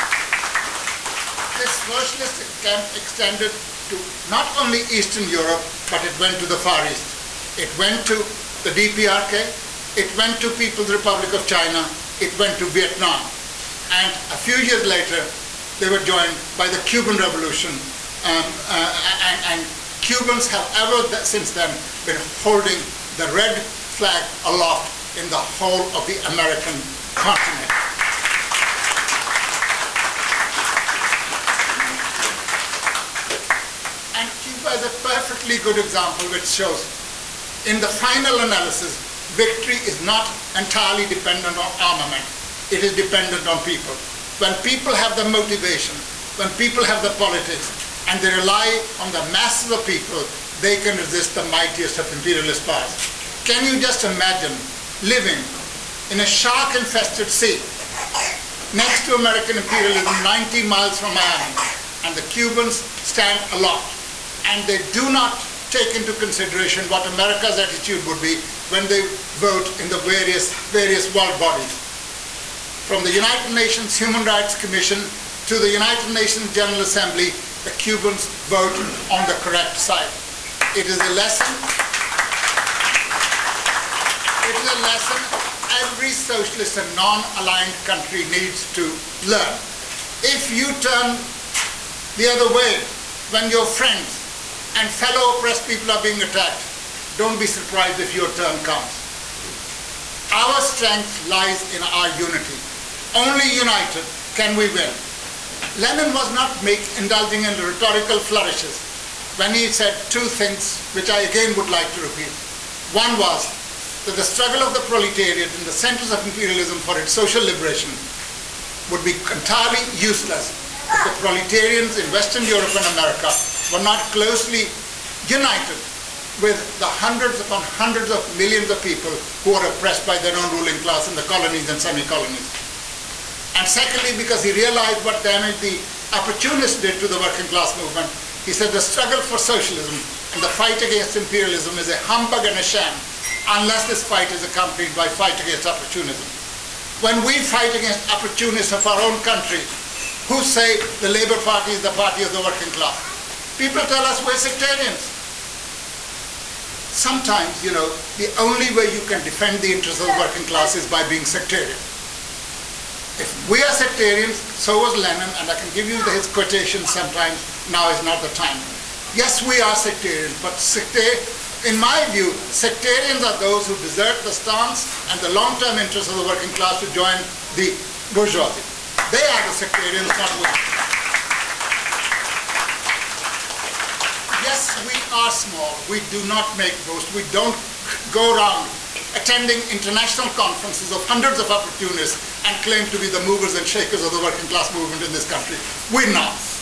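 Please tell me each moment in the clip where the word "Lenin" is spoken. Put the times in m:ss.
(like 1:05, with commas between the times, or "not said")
1:45, 2:45.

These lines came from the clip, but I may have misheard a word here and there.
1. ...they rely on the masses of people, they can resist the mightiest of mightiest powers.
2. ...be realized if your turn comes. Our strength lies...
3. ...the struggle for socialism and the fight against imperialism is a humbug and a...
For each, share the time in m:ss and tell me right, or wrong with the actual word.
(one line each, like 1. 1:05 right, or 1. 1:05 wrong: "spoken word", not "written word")
1. 0:48 wrong: "imperialist", not "mightiest"
2. 1:37 wrong: "surprised", not "realized"
3. 2:18 right.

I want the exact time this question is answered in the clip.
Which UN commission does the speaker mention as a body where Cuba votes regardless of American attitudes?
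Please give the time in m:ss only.
1:13.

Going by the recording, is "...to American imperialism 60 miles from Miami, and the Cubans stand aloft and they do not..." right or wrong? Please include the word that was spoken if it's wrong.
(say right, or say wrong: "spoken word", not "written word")
wrong: "90", not "60".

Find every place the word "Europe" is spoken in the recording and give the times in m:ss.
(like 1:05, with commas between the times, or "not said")
0:05, 2:02.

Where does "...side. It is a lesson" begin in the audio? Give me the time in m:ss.
1:19.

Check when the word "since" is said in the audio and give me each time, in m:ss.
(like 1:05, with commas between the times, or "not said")
0:21.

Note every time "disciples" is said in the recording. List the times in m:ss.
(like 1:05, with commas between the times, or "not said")
not said.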